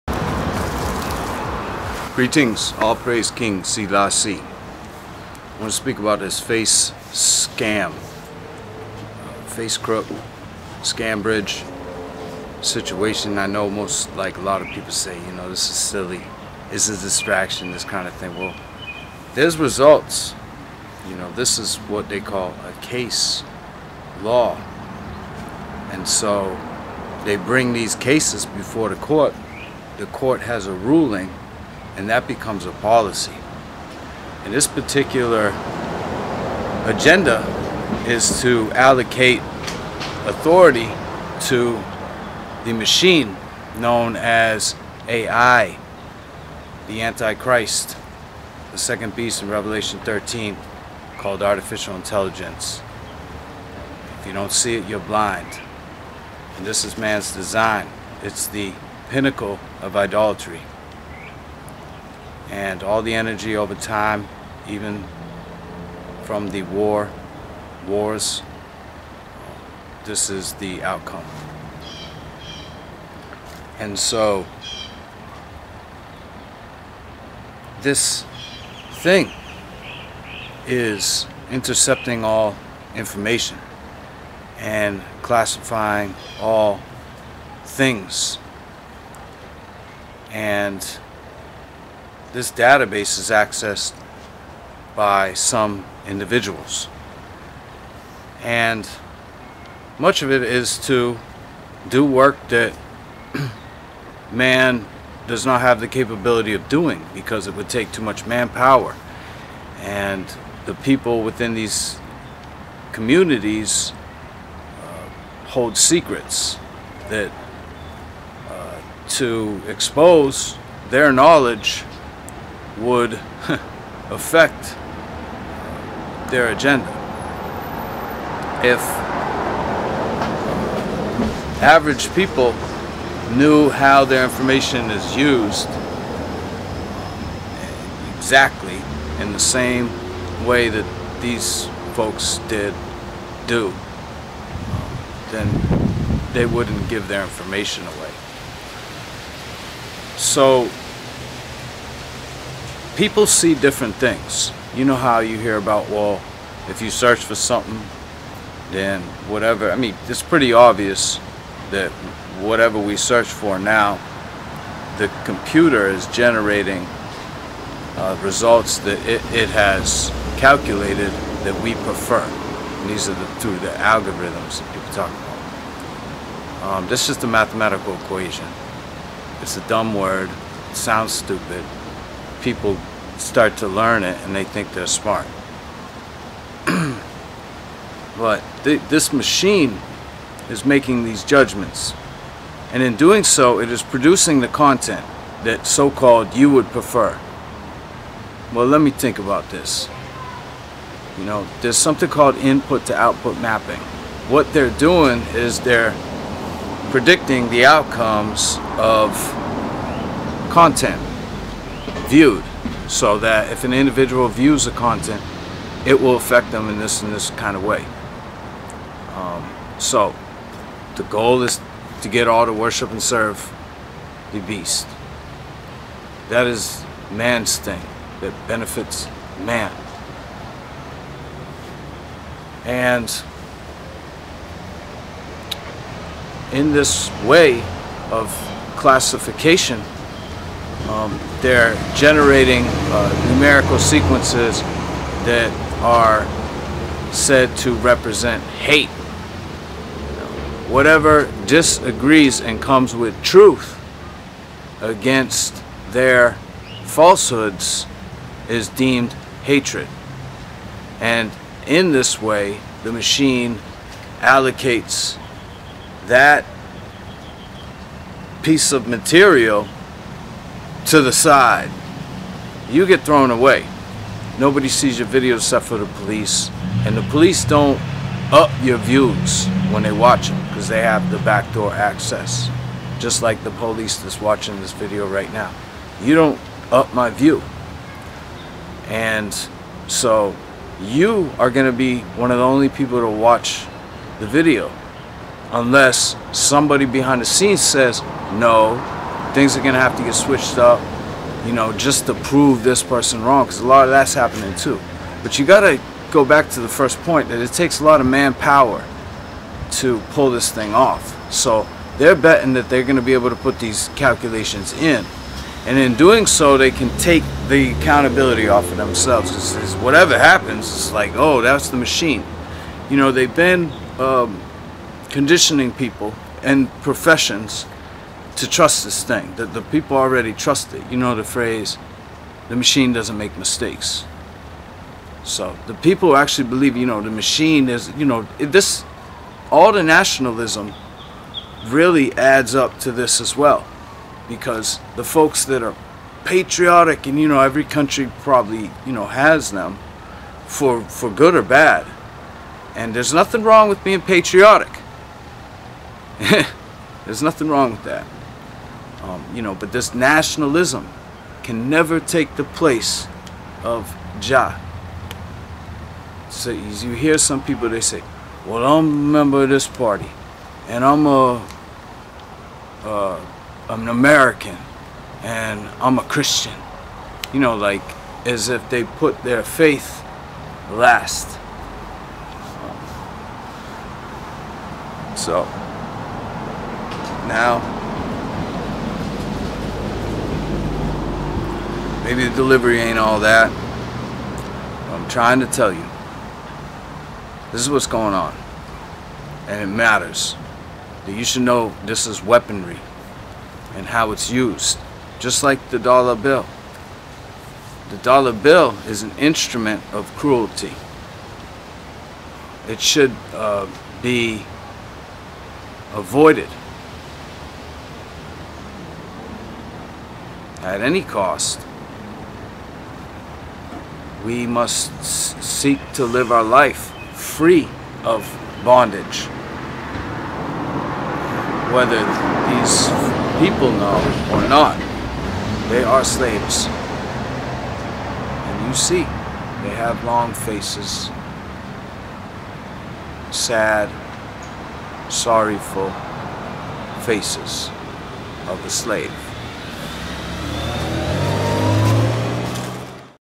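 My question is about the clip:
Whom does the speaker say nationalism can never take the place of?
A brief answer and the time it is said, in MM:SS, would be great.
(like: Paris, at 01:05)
Jah, at 06:04.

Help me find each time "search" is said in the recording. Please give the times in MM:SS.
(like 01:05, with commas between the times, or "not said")
02:36, 02:42.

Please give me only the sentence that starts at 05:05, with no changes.
But you gotta go back to the first point that it takes a lot of manpower to pull this thing off.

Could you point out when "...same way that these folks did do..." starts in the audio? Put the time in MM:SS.
02:19.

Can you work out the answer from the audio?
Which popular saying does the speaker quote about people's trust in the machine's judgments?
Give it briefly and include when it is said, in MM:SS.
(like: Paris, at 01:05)
the machine doesn't make mistakes, at 05:32.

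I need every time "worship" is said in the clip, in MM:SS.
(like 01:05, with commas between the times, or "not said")
03:42.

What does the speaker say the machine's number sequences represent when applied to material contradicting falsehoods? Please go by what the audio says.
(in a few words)
hate.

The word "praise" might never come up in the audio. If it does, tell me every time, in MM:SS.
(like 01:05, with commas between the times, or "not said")
00:02.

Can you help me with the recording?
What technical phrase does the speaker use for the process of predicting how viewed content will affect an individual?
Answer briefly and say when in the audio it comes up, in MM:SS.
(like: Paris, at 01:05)
input to output mapping, at 03:22.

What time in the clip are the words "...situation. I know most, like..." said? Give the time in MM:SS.
00:12.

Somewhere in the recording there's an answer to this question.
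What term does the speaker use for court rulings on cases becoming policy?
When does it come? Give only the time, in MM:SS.
00:22.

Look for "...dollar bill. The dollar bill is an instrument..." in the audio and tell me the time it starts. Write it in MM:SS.
06:45.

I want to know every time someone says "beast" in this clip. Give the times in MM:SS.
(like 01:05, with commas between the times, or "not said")
00:49, 03:44.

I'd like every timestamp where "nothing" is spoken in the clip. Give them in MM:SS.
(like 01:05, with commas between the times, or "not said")
05:53, 05:57.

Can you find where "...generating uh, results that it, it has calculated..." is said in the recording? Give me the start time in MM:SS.
02:46.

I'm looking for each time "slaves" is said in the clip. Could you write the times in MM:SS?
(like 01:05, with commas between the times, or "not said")
07:16, 07:28.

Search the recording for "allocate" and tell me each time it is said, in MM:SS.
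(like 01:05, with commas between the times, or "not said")
00:38, 04:24.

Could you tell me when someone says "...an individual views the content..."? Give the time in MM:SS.
03:33.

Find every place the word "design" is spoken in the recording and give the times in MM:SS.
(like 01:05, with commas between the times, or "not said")
00:57.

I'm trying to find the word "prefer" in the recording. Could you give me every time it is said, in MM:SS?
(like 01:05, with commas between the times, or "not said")
02:51, 03:16.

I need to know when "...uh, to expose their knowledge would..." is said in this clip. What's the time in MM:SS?
01:58.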